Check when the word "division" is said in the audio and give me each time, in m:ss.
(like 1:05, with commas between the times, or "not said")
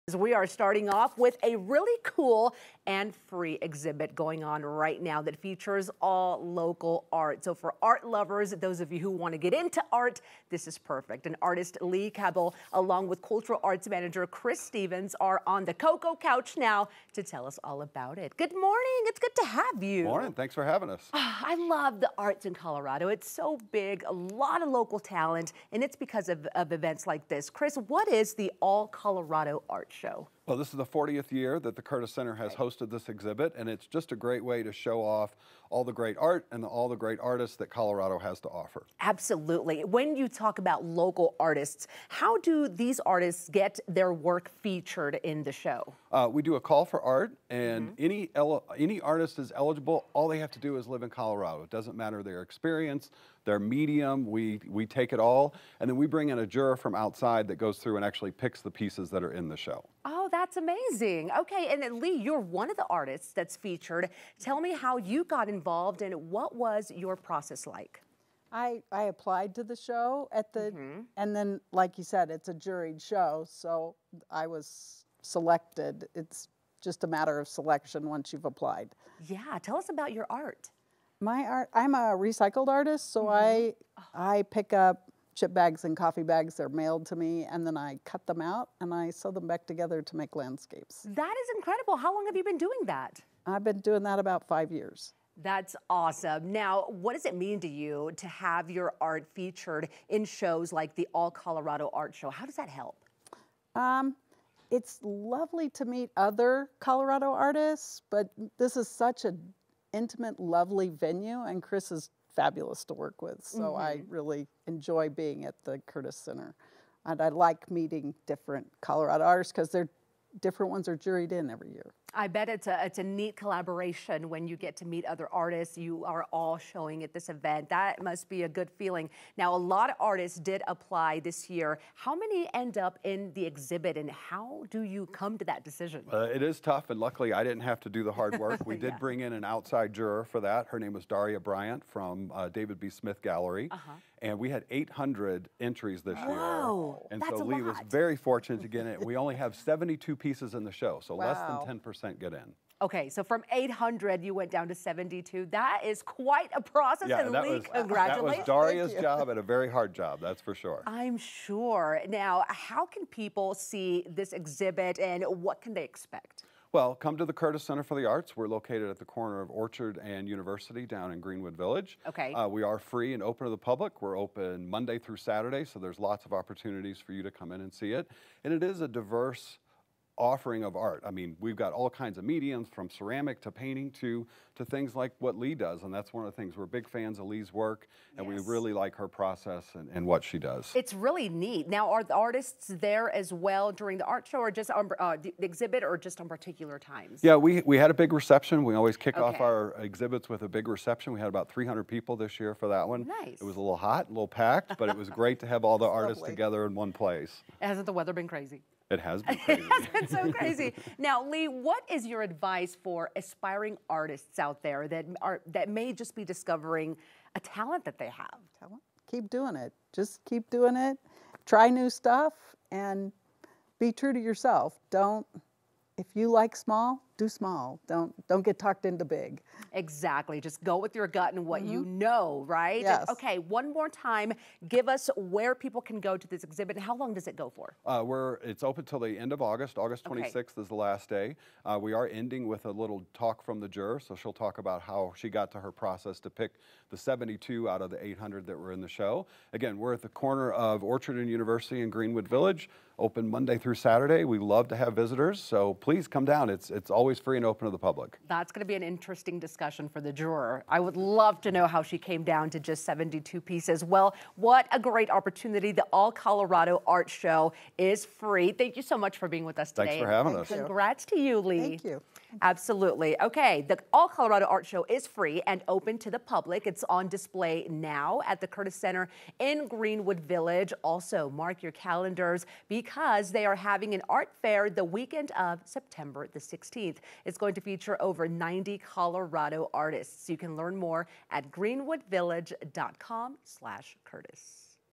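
not said.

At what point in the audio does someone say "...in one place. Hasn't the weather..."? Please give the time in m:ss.
3:26.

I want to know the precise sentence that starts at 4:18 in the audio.
That's going to be an interesting discussion for the juror.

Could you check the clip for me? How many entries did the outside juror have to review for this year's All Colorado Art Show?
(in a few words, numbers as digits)
800.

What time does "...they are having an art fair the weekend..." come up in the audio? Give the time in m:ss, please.
4:43.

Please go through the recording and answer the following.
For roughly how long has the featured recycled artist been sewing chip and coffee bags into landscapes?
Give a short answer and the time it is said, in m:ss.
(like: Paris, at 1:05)
About 5 years, at 1:34.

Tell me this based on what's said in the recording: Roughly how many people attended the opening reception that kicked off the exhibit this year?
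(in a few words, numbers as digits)
300.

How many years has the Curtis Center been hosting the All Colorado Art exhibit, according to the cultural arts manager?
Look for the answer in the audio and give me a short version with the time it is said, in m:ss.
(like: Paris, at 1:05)
40, at 0:30.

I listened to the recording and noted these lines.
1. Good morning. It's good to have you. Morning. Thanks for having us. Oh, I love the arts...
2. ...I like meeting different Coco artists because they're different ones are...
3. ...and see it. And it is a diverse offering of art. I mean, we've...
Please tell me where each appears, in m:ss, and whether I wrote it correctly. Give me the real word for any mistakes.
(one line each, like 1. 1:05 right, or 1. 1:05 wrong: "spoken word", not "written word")
1. 0:18 right
2. 1:57 wrong: "Colorado", not "Coco"
3. 2:57 right.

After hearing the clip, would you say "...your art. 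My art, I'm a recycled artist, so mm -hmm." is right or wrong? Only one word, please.
right.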